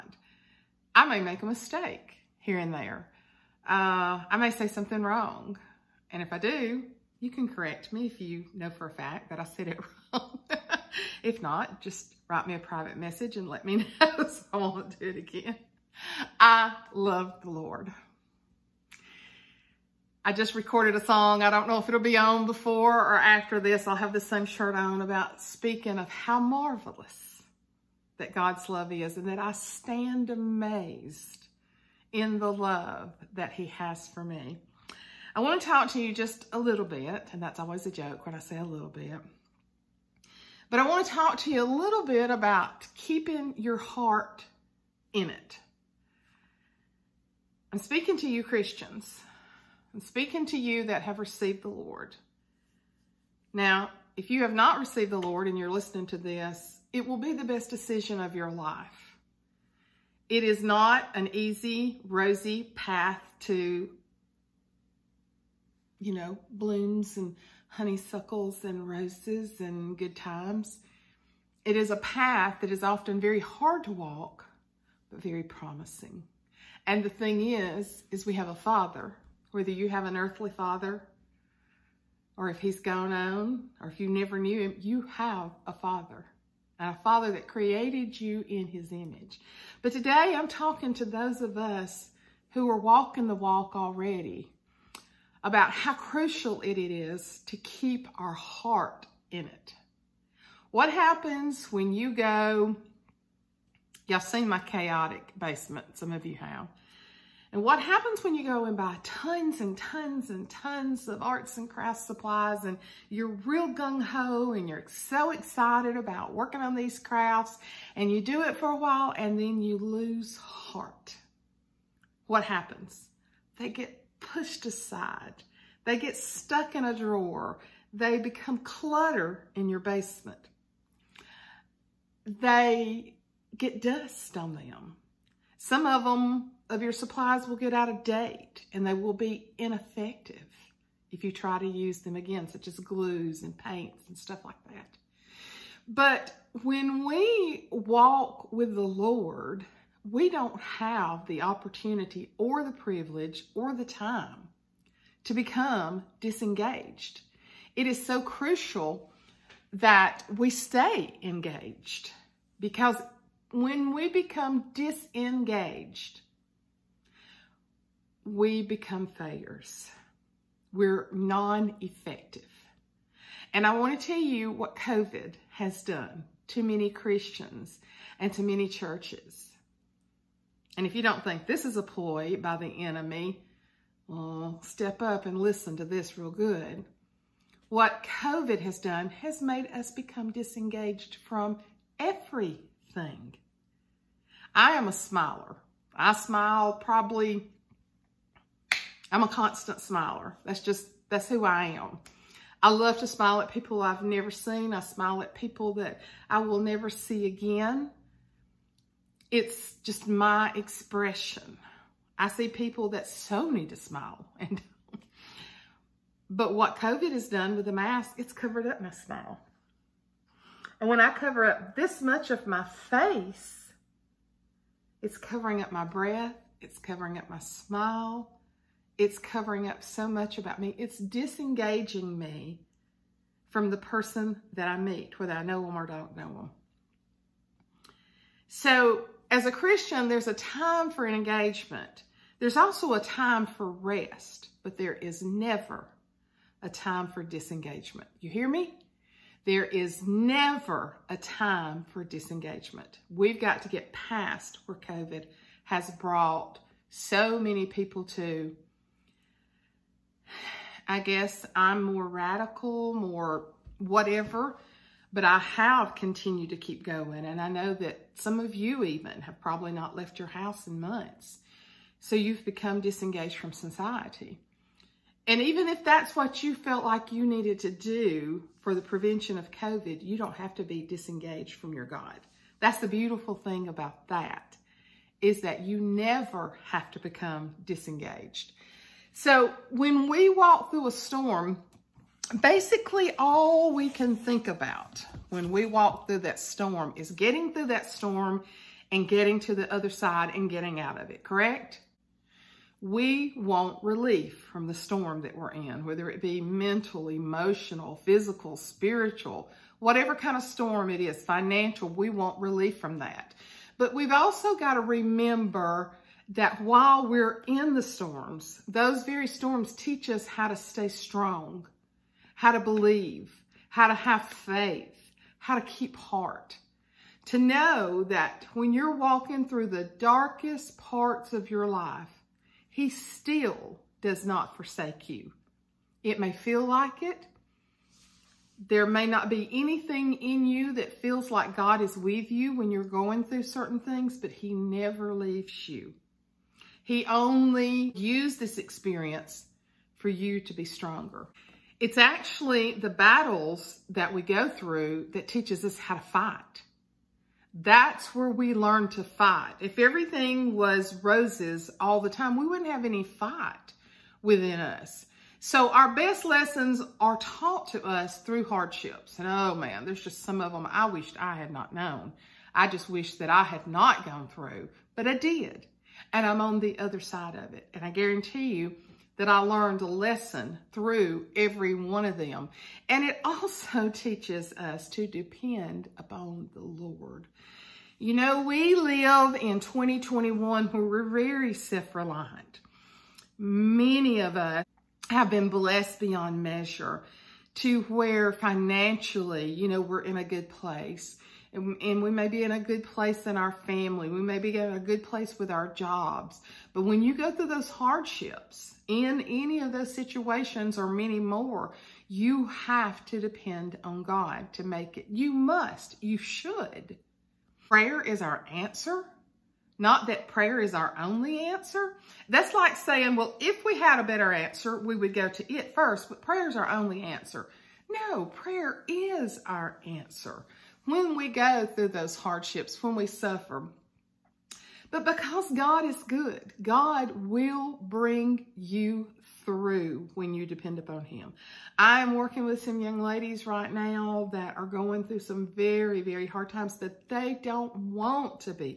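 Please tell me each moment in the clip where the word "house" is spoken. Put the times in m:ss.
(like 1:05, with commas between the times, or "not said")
4:30.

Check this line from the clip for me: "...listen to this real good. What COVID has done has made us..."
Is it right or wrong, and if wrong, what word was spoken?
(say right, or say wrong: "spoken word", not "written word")
right.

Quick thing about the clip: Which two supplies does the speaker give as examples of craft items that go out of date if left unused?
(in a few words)
Glues and paints.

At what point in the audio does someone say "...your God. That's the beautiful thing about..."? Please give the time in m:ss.
4:41.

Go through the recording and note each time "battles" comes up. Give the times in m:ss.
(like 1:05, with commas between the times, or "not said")
5:52.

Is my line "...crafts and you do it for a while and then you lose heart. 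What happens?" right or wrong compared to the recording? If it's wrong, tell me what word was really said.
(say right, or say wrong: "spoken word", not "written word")
right.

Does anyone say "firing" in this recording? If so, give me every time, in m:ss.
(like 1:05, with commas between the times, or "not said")
not said.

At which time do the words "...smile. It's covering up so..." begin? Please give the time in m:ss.
3:47.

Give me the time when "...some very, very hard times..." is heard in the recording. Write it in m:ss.
7:25.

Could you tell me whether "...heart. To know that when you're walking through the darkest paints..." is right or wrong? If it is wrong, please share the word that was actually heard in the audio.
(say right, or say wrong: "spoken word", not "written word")
wrong: "parts", not "paints".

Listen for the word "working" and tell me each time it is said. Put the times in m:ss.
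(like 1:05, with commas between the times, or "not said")
1:56, 7:22.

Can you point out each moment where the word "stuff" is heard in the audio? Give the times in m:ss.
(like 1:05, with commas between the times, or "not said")
2:24.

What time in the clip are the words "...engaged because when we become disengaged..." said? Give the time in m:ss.
2:41.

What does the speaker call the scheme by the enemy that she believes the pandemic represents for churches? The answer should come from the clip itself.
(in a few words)
A ploy.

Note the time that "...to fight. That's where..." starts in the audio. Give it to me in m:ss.
5:55.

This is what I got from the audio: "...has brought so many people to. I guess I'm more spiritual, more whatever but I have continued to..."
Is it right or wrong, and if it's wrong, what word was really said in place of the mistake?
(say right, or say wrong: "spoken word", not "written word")
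wrong: "radical", not "spiritual".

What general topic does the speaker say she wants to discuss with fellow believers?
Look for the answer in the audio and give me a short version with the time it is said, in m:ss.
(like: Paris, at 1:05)
Keeping your heart in it, at 0:42.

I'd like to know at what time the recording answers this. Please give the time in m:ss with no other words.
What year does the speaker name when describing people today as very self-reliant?
6:29.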